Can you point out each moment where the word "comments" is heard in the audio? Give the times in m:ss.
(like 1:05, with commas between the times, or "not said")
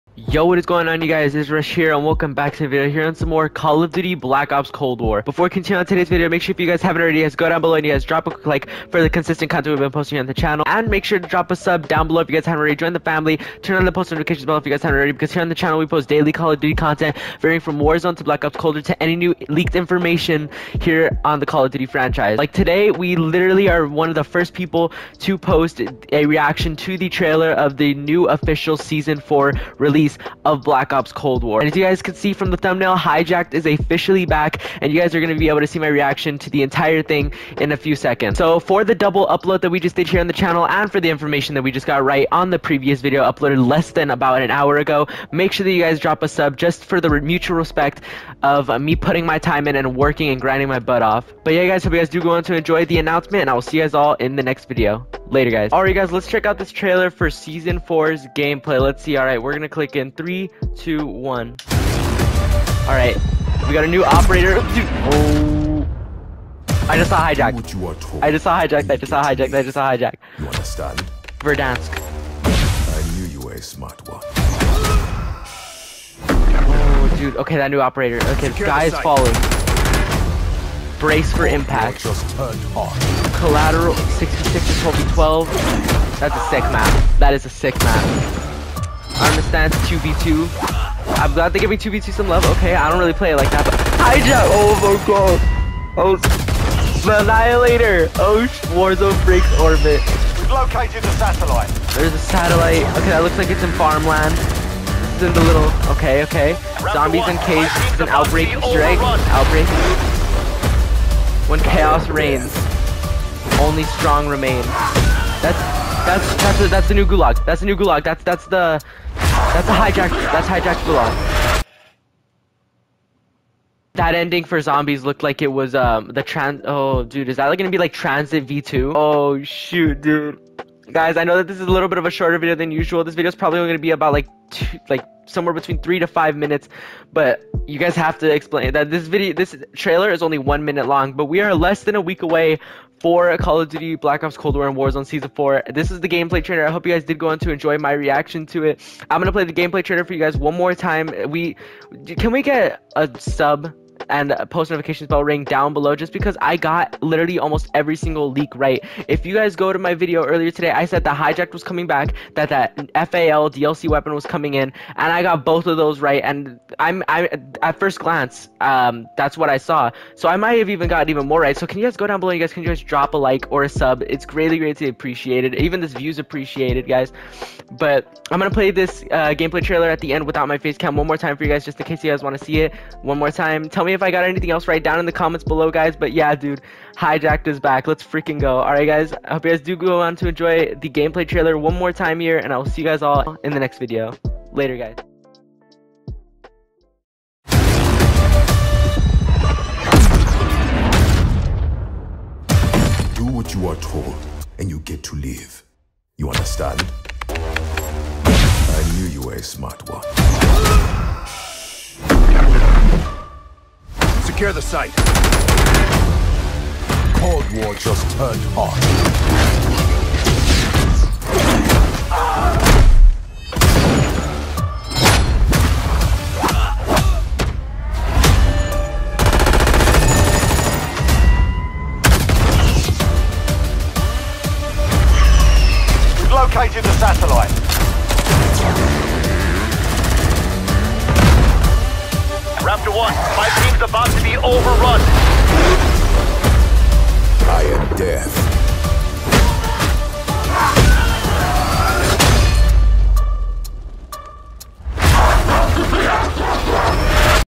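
3:05.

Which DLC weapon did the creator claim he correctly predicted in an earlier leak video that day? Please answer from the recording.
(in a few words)
FAL.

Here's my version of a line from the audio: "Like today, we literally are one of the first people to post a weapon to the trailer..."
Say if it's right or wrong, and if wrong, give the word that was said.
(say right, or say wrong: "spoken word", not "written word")
wrong: "reaction", not "weapon".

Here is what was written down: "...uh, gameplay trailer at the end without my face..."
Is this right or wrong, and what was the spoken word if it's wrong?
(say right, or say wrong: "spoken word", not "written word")
right.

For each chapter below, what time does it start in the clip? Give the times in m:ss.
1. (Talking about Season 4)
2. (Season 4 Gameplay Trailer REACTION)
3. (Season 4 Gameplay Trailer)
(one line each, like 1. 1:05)
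1. 2:04
2. 0:56
3. 3:17.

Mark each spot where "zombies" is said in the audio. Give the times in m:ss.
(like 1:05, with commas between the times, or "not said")
1:46, 2:04.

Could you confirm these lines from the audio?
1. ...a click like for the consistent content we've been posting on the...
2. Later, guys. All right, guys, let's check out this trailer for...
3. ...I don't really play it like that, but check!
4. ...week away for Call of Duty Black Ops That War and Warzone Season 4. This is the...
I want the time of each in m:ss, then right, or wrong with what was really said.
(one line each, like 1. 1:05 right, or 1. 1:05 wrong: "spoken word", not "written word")
1. 0:08 wrong: "quick", not "click"
2. 0:55 right
3. 1:32 wrong: "hijack", not "check"
4. 2:22 wrong: "Cold", not "That".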